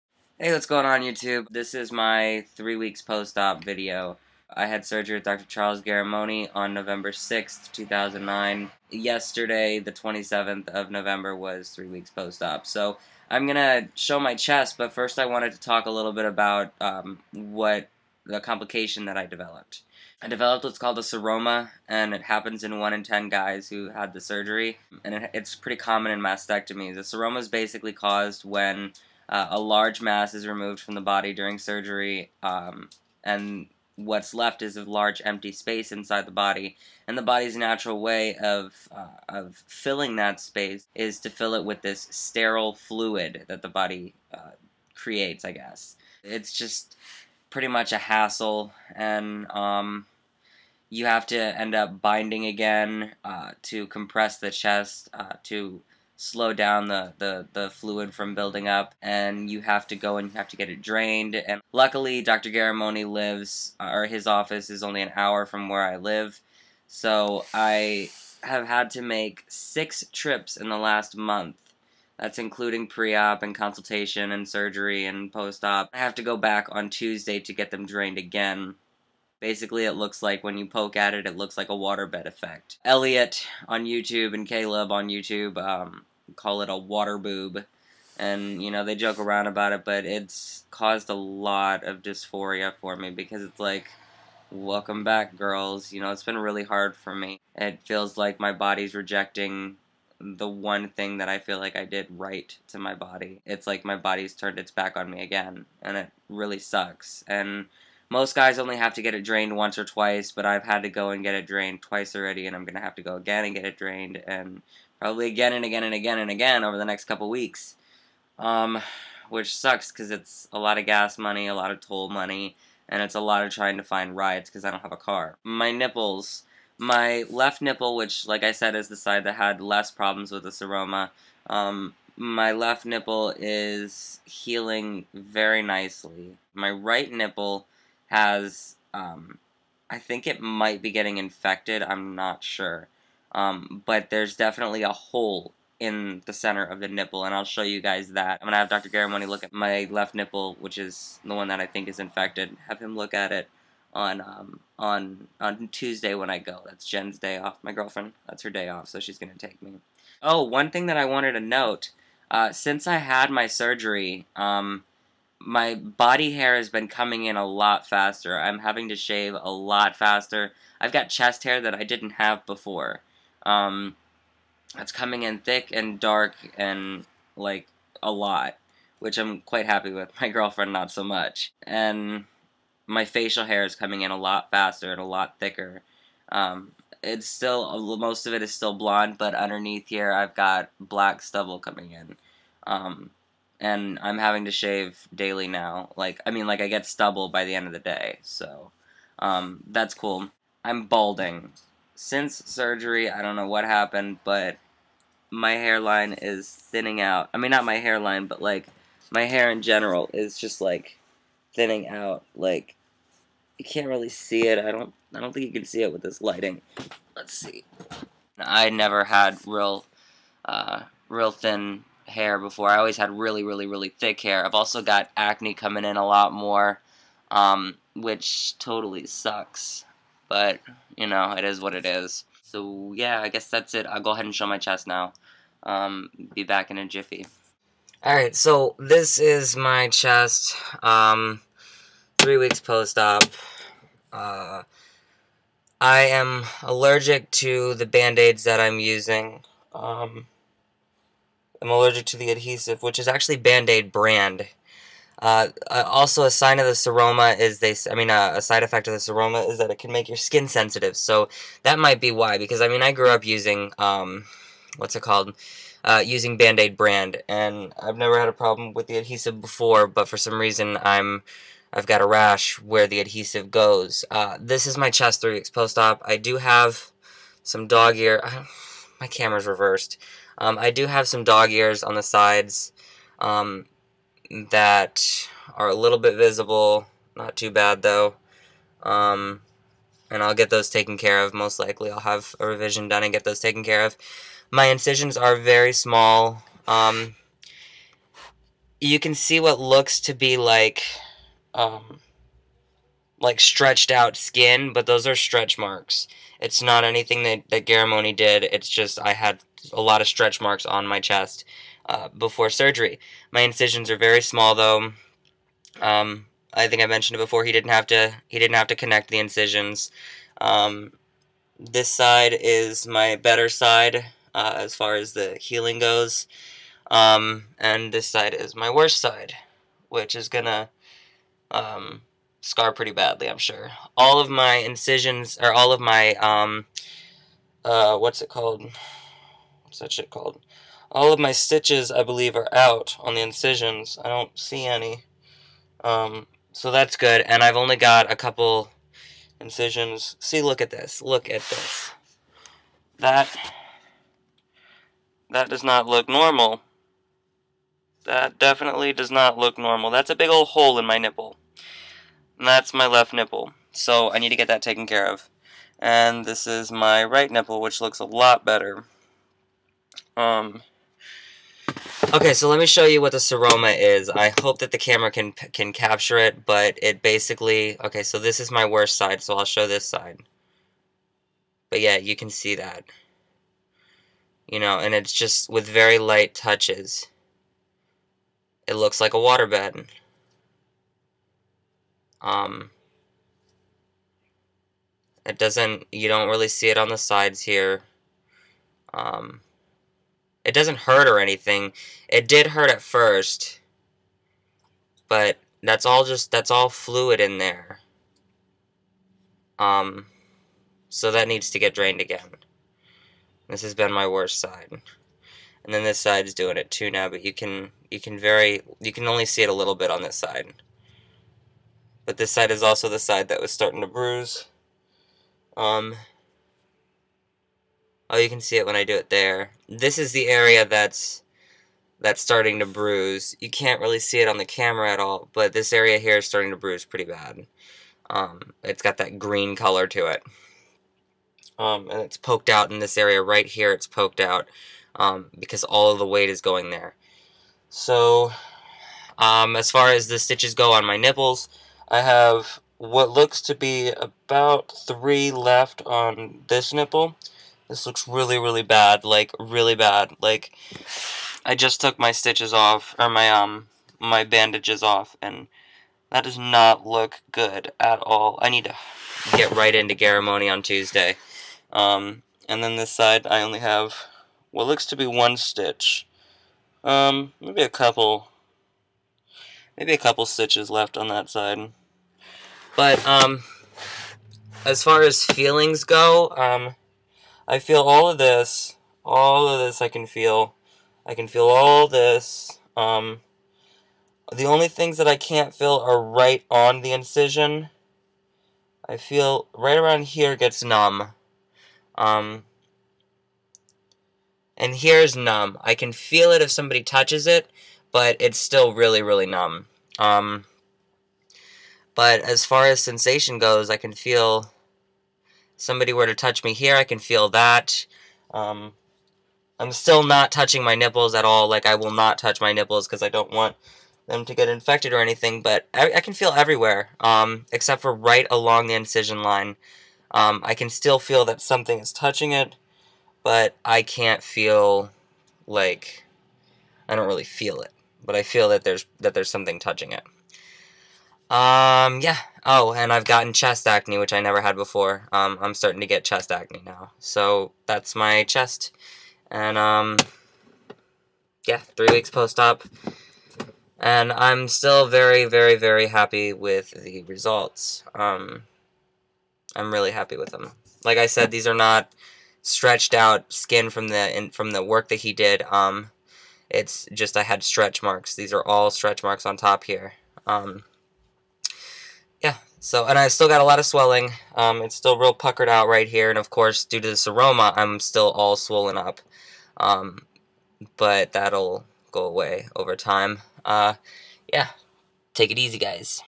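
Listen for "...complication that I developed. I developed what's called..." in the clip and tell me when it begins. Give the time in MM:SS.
00:18.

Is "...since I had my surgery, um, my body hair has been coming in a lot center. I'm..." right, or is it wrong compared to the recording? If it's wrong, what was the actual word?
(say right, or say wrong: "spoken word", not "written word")
wrong: "faster", not "center".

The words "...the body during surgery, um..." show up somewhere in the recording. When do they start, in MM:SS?
00:30.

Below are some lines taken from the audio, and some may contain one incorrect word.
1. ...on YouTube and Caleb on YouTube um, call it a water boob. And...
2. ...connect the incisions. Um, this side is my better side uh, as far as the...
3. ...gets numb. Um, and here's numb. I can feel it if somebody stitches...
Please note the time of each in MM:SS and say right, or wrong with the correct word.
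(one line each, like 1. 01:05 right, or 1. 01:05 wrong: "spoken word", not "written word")
1. 01:23 right
2. 05:18 right
3. 08:20 wrong: "touches", not "stitches".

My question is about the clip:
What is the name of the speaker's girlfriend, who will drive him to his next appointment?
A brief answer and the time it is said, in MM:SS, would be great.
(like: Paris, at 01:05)
Jen, at 02:36.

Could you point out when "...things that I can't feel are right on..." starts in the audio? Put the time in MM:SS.
08:14.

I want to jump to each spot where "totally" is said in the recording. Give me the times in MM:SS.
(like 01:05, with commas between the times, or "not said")
03:48.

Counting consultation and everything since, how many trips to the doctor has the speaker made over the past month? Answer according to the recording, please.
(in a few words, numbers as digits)
6.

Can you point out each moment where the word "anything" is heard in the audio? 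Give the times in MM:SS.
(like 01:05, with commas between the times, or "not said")
05:06, 06:41, 08:44.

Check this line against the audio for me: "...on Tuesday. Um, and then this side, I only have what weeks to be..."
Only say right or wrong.
wrong.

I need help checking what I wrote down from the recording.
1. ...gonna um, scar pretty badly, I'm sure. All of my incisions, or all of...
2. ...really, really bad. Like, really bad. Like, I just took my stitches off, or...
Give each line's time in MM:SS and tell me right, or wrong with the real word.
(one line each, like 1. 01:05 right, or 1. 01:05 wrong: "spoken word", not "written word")
1. 05:30 right
2. 07:38 right.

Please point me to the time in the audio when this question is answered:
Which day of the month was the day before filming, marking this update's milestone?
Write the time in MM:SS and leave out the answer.
00:09.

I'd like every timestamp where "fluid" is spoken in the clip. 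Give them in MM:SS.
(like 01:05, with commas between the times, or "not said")
00:42, 00:57, 06:46.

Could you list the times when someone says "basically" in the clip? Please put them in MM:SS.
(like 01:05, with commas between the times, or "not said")
00:27, 01:19, 06:17.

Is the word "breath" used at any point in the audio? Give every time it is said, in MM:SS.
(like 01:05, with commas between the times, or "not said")
not said.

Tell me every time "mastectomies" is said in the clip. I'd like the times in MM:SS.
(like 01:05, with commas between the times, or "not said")
00:26.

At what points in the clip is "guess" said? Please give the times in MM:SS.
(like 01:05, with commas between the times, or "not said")
00:45, 03:53.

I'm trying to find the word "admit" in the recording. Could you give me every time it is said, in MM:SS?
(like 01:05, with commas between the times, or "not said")
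not said.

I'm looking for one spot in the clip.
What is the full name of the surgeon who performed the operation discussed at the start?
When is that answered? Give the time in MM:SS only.
00:05.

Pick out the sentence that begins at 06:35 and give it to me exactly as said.
You don't really see it on the sides here.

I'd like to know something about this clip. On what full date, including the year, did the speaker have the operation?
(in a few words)
November 6, 2009.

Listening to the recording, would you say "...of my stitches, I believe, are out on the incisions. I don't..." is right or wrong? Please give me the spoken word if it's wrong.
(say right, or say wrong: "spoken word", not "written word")
right.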